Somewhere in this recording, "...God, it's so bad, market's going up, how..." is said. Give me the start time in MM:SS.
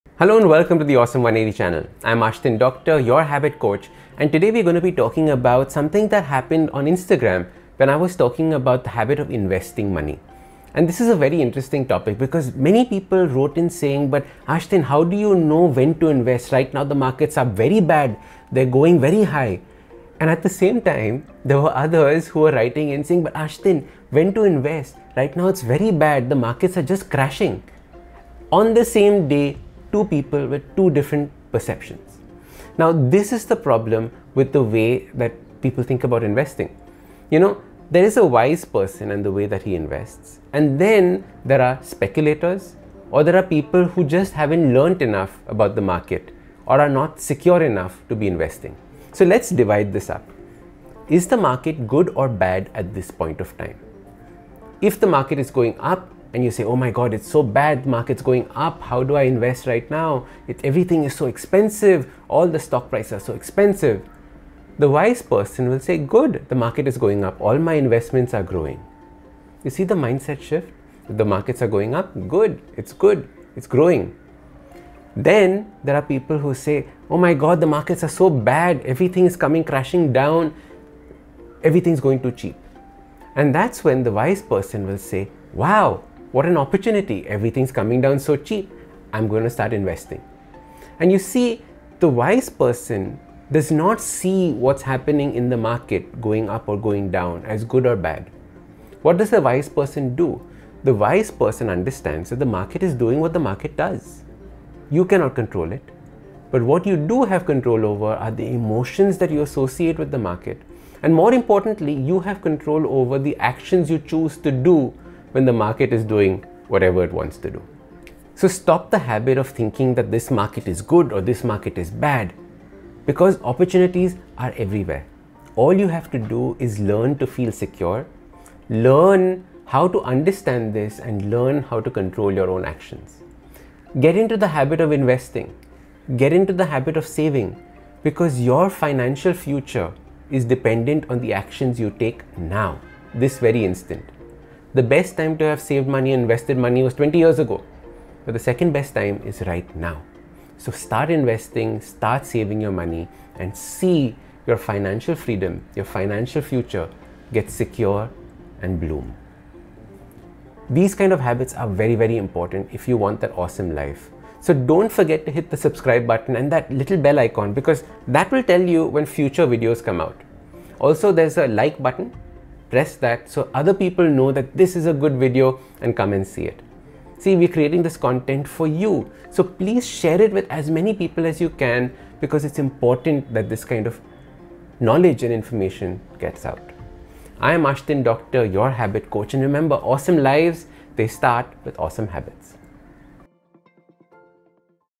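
00:56.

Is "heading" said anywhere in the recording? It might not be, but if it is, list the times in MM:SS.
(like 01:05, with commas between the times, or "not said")
not said.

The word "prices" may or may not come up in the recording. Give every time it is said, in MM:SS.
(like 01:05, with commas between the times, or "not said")
01:02.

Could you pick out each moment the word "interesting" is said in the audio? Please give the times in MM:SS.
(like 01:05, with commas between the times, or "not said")
00:11.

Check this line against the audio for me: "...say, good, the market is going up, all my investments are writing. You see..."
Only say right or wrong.
wrong.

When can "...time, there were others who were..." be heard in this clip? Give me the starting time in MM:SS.
00:20.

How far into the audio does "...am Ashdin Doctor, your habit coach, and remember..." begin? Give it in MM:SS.
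03:07.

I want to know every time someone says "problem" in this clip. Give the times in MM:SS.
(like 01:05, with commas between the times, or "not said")
00:33.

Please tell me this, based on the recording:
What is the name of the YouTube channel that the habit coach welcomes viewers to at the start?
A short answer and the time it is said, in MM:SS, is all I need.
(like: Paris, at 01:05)
Awesome 180, at 00:00.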